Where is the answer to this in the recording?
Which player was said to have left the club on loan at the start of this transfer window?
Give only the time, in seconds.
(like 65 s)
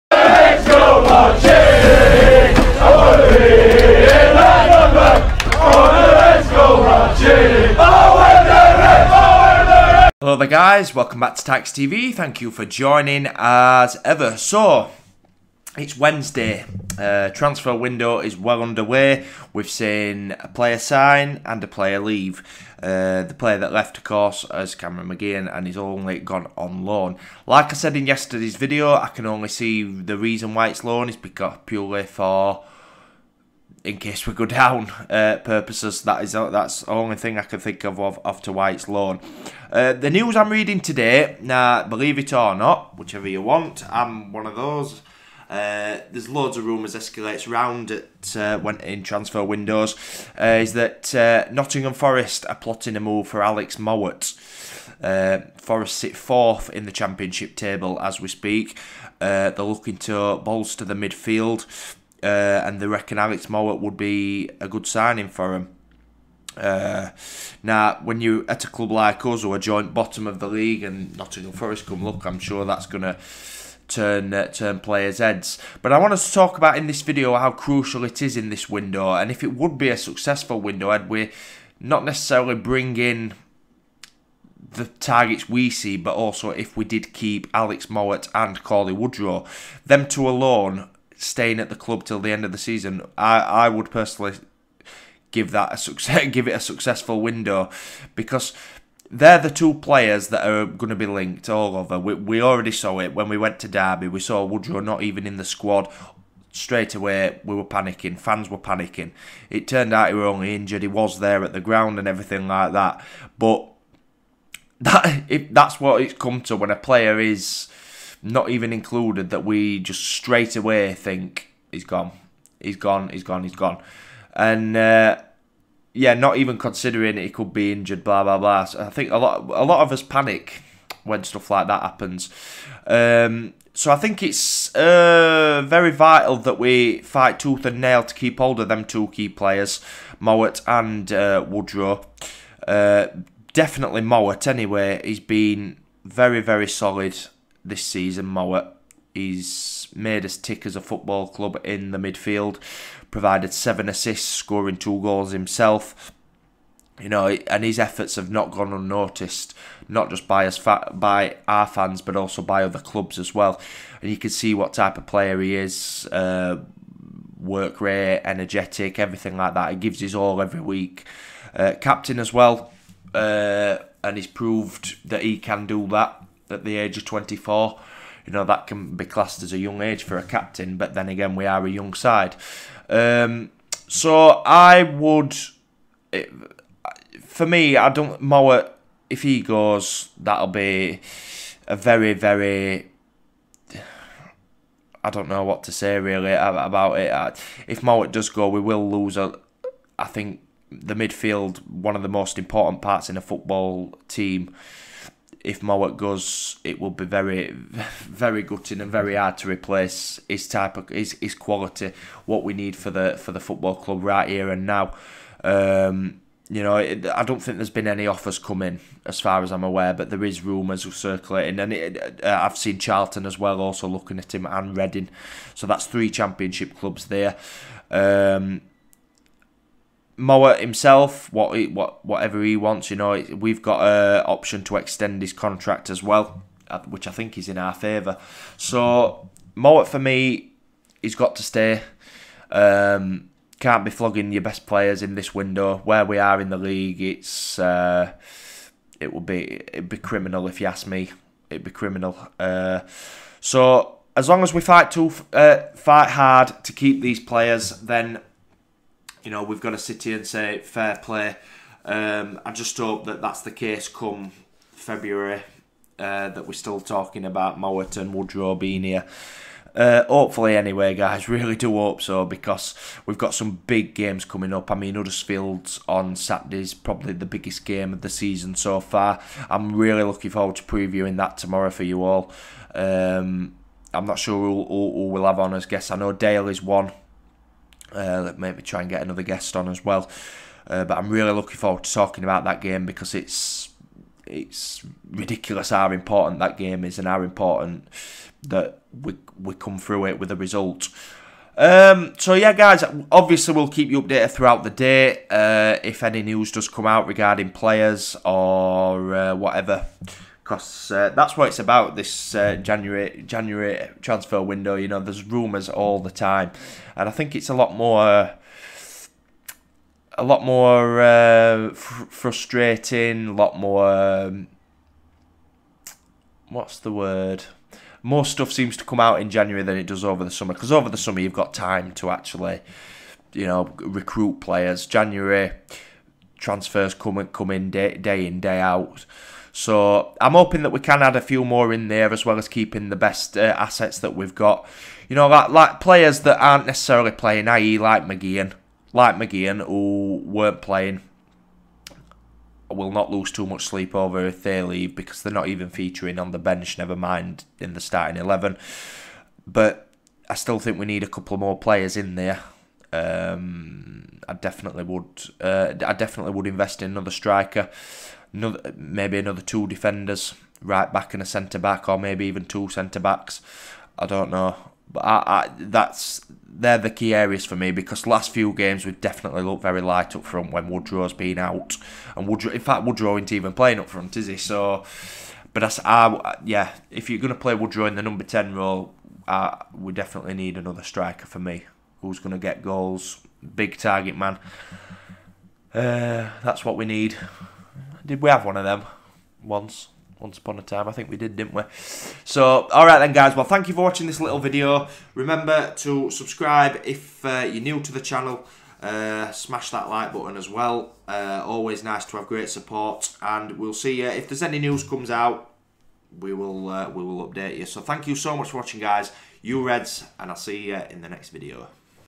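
24 s.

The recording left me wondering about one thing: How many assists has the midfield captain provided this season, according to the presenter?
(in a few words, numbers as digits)
7.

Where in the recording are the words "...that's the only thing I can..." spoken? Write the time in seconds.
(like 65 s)
36 s.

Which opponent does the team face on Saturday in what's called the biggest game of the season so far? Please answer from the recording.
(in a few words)
Huddersfield.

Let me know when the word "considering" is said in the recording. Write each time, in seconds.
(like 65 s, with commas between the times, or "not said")
126 s.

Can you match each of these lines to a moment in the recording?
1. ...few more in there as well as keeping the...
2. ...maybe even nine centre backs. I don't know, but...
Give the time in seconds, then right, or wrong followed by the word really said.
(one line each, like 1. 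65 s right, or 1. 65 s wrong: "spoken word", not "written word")
1. 341 s right
2. 371 s wrong: "two", not "nine".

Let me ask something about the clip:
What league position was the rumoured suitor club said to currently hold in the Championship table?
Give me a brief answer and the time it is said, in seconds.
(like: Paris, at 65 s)
Fourth, at 56 s.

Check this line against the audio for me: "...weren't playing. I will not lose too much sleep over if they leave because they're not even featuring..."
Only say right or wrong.
right.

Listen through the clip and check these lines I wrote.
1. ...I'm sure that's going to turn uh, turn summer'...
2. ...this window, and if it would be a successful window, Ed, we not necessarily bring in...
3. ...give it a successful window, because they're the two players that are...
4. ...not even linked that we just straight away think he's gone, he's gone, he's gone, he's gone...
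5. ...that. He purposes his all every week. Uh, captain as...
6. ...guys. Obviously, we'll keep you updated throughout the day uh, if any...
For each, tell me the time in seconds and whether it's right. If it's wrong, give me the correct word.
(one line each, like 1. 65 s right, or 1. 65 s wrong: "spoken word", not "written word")
1. 72 s wrong: "players", not "summer"
2. 78 s right
3. 96 s right
4. 118 s wrong: "included", not "linked"
5. 169 s wrong: "gives", not "purposes"
6. 302 s right.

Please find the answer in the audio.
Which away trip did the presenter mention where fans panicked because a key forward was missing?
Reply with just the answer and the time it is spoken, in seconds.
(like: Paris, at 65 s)
Derby, at 103 s.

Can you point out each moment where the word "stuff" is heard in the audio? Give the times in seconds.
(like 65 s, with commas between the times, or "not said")
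131 s, 328 s.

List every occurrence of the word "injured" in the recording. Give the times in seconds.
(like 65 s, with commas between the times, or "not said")
110 s, 127 s.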